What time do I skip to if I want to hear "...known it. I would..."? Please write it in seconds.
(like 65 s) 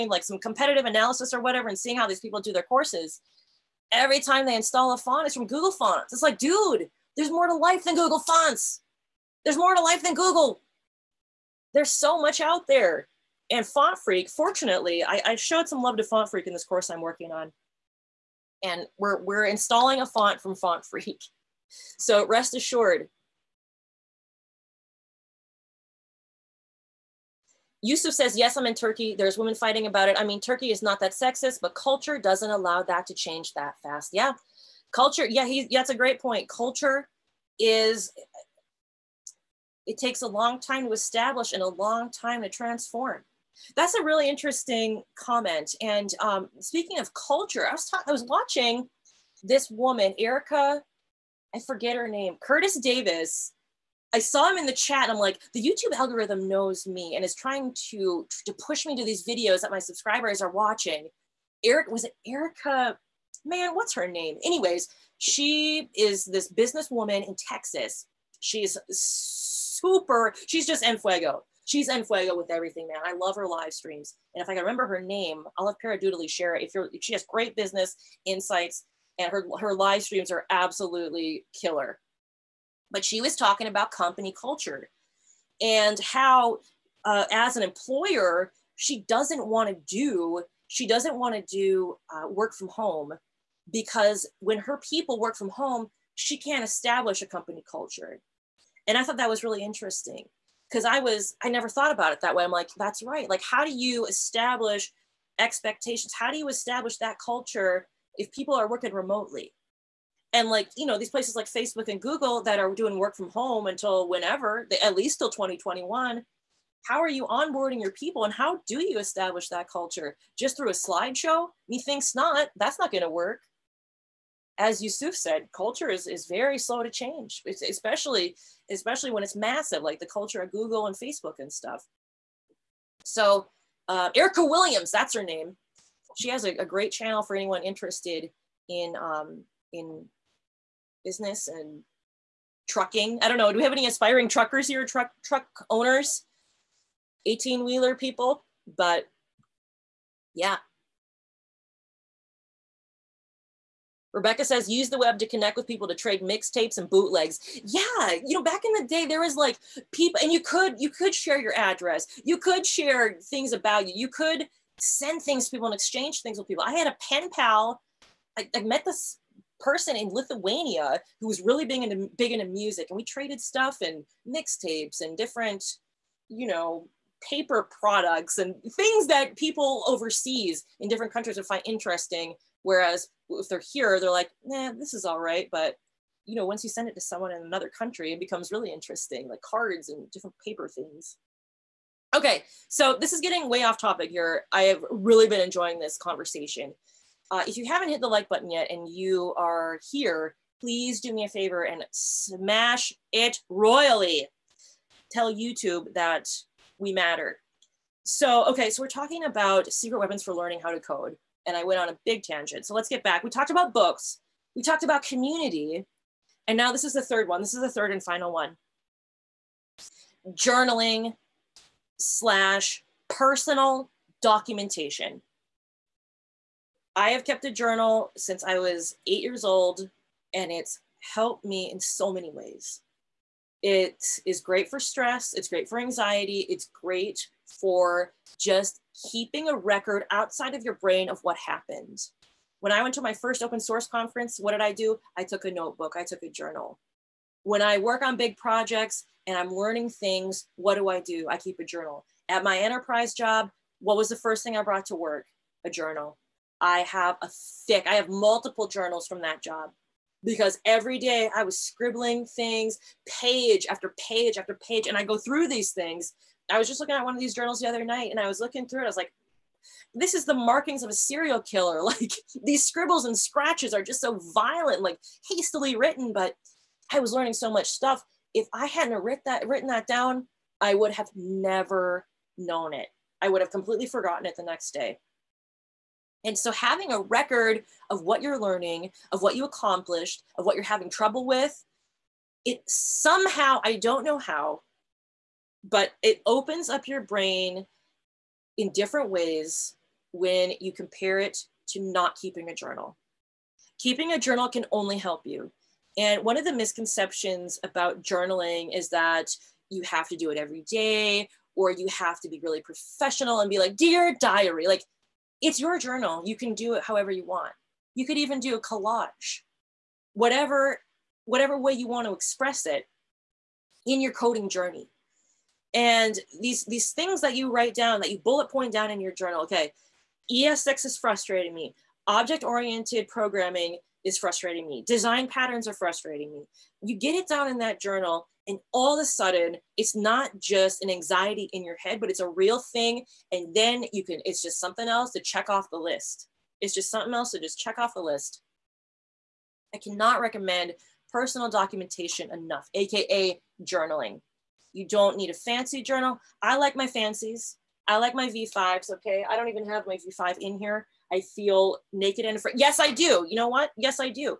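282 s.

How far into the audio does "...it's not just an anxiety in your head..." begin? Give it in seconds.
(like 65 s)
339 s.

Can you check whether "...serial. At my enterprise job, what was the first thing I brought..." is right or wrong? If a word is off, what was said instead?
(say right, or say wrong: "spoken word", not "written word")
wrong: "journal", not "serial".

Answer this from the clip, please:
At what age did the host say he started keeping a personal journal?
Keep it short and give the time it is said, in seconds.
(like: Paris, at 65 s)
8, at 229 s.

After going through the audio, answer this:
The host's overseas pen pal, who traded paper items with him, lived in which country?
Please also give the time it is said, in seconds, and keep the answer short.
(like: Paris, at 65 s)
Lithuania, at 170 s.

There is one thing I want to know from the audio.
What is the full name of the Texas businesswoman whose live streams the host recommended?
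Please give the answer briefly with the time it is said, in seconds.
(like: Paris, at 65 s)
Erica Williams, at 134 s.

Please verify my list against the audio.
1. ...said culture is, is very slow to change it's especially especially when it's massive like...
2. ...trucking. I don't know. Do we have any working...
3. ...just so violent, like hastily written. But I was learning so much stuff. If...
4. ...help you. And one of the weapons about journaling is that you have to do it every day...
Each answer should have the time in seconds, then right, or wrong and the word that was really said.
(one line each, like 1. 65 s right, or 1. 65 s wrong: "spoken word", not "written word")
1. 125 s right
2. 142 s wrong: "aspiring", not "working"
3. 273 s right
4. 304 s wrong: "misconceptions", not "weapons".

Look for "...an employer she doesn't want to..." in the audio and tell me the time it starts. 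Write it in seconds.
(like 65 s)
87 s.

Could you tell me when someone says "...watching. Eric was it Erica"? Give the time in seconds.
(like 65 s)
60 s.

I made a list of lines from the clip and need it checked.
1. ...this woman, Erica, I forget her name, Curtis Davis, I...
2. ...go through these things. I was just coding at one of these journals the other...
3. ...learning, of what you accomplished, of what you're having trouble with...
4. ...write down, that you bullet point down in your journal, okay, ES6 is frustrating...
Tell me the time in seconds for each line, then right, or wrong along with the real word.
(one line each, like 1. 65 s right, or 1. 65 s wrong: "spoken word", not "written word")
1. 49 s right
2. 265 s wrong: "looking", not "coding"
3. 288 s right
4. 327 s right.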